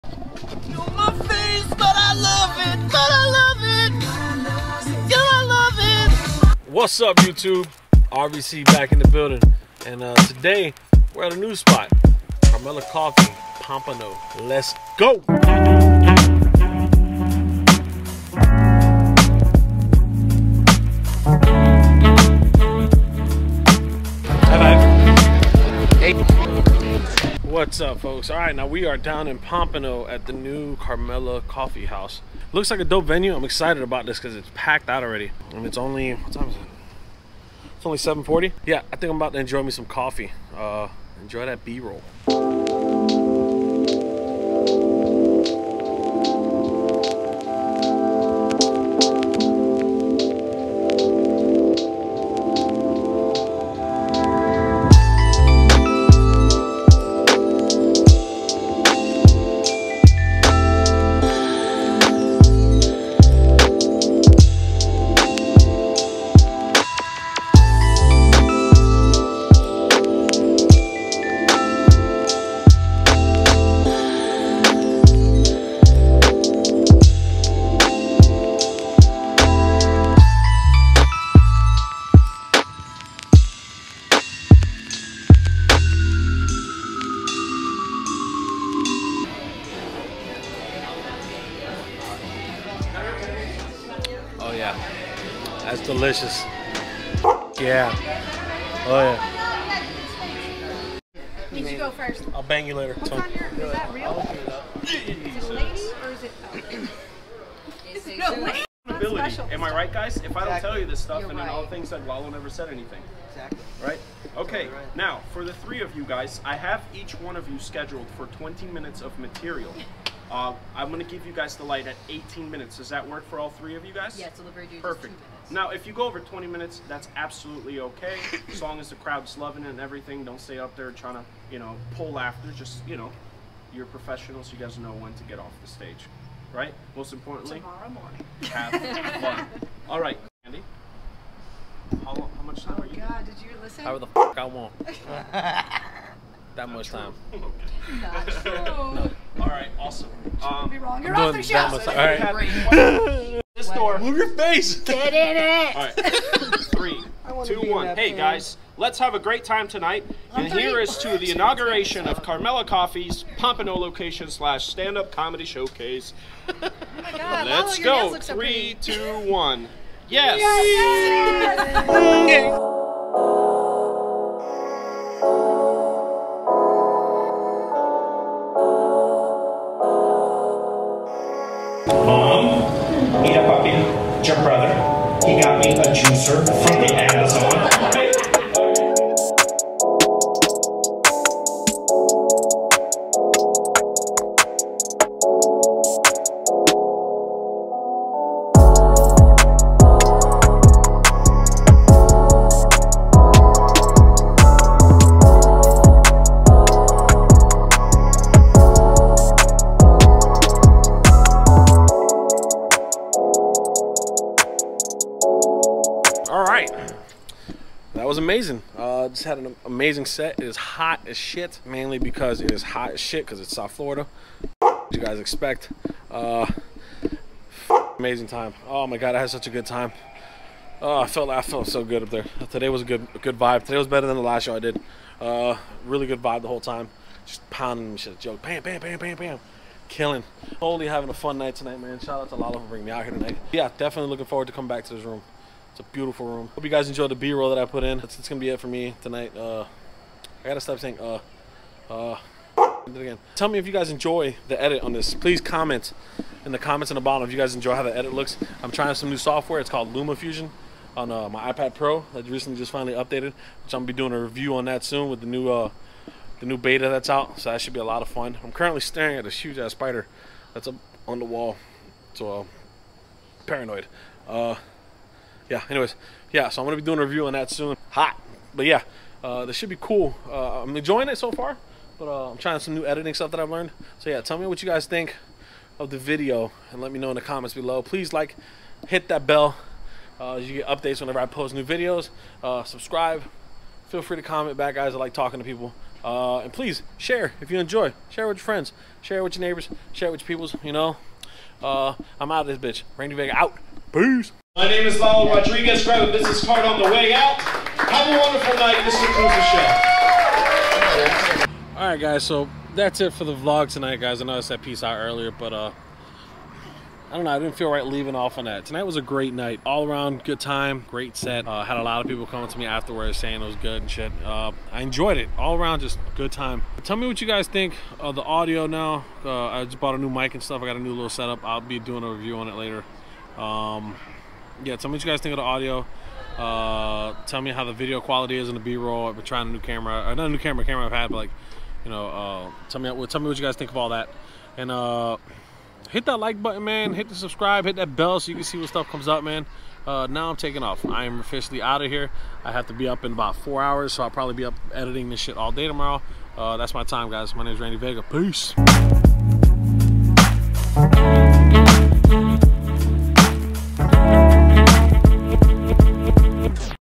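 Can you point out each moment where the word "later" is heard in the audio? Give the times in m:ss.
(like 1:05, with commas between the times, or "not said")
1:42, 5:32.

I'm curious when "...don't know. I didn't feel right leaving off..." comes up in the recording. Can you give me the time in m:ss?
5:17.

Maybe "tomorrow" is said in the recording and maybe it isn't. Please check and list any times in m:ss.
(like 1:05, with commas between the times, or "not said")
2:17, 5:55.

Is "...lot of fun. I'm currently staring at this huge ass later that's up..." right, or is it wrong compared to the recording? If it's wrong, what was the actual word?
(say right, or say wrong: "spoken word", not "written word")
wrong: "spider", not "later".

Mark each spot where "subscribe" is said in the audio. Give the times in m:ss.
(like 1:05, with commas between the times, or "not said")
4:52, 5:47.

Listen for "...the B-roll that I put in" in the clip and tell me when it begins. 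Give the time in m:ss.
4:07.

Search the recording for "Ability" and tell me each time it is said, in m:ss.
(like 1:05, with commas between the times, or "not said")
1:48.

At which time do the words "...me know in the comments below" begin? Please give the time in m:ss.
4:46.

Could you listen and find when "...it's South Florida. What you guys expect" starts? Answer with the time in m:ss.
3:43.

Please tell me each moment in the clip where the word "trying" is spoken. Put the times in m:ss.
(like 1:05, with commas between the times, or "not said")
2:10, 4:18, 4:42, 5:39.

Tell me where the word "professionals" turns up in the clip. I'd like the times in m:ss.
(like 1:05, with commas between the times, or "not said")
2:13.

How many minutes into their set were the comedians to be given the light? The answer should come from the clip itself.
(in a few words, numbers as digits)
18 minutes.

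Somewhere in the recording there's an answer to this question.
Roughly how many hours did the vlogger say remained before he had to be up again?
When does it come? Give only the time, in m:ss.
5:53.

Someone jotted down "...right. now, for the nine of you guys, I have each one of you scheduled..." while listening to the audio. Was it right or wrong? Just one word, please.
wrong.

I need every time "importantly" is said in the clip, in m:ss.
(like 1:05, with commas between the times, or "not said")
2:17.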